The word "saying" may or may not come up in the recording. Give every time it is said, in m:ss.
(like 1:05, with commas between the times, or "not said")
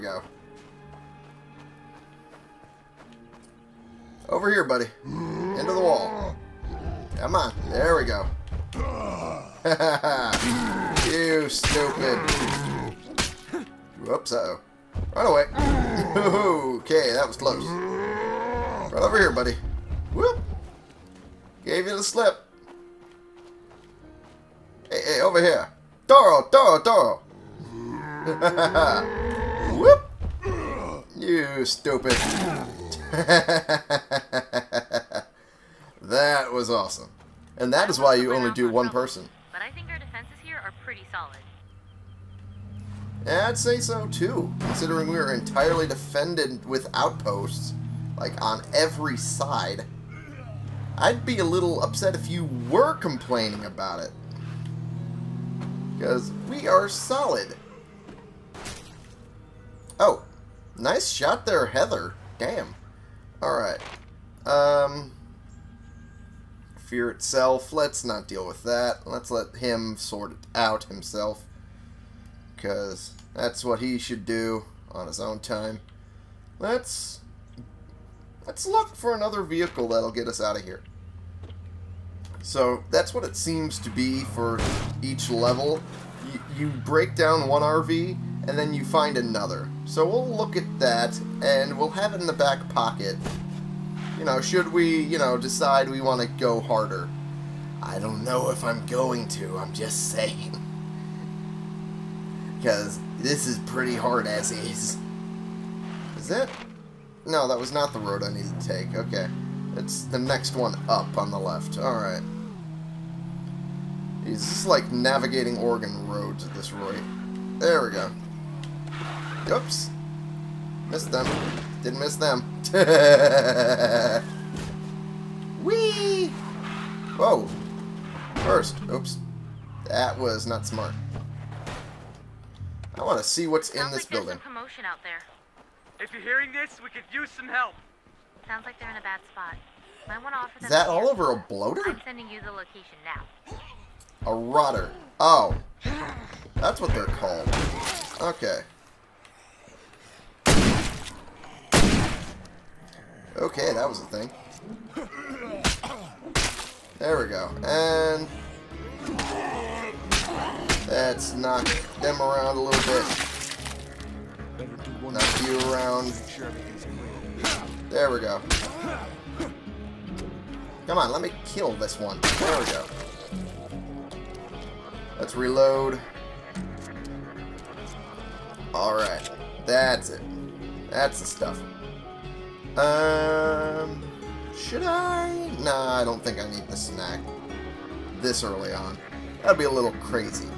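1:40.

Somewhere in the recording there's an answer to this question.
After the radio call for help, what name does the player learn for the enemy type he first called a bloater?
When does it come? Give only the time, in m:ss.
2:24.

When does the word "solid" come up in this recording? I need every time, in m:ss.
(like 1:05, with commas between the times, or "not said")
0:41, 0:56.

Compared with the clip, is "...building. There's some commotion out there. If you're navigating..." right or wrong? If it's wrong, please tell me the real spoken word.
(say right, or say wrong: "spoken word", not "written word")
wrong: "hearing", not "navigating".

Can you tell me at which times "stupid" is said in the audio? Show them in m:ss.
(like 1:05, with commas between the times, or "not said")
0:11, 0:31.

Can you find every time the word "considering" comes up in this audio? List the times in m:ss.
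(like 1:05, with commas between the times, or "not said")
0:44.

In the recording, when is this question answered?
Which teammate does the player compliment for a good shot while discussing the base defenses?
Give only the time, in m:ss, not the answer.
1:01.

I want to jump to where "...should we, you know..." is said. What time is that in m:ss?
1:34.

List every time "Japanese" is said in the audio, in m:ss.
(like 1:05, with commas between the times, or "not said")
not said.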